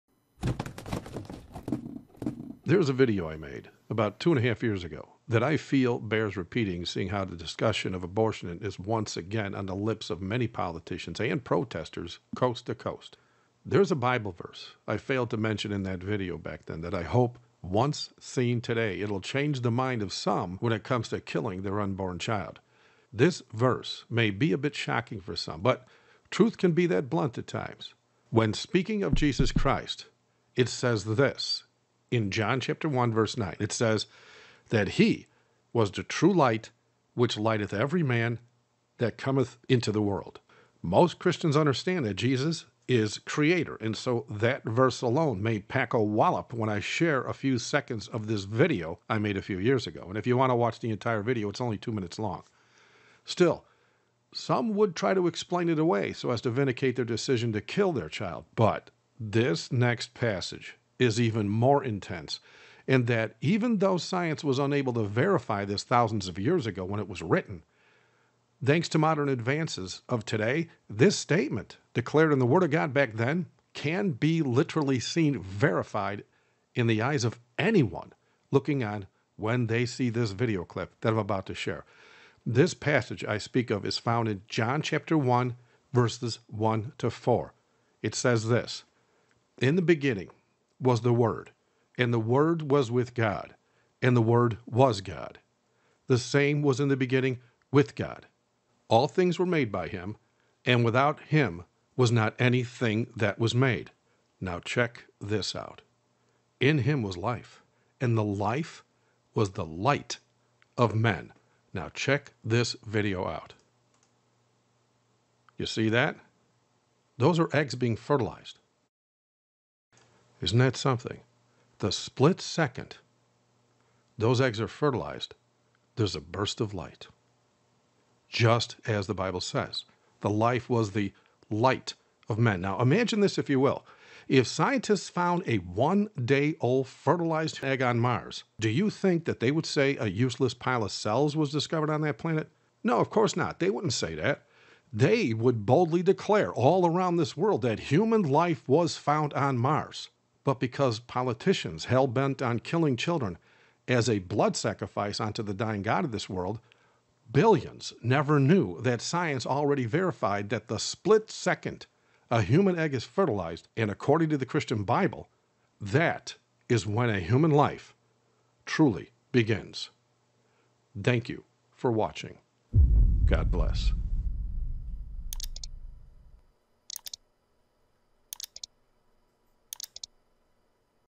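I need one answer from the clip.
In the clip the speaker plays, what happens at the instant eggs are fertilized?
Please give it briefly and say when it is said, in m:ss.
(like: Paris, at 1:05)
A burst of light, at 2:06.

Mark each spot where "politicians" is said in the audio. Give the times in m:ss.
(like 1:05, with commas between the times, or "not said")
0:10, 2:30.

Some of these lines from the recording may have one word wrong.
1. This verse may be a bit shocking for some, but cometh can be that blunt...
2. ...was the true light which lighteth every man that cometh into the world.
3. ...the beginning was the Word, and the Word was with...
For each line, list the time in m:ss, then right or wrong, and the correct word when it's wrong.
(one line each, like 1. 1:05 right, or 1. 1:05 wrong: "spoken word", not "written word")
1. 0:23 wrong: "truth", not "cometh"
2. 0:35 right
3. 1:29 right.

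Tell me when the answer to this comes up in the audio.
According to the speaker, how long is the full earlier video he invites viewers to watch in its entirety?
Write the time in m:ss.
0:51.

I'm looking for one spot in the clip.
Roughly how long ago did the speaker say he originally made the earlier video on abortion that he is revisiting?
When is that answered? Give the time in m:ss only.
0:04.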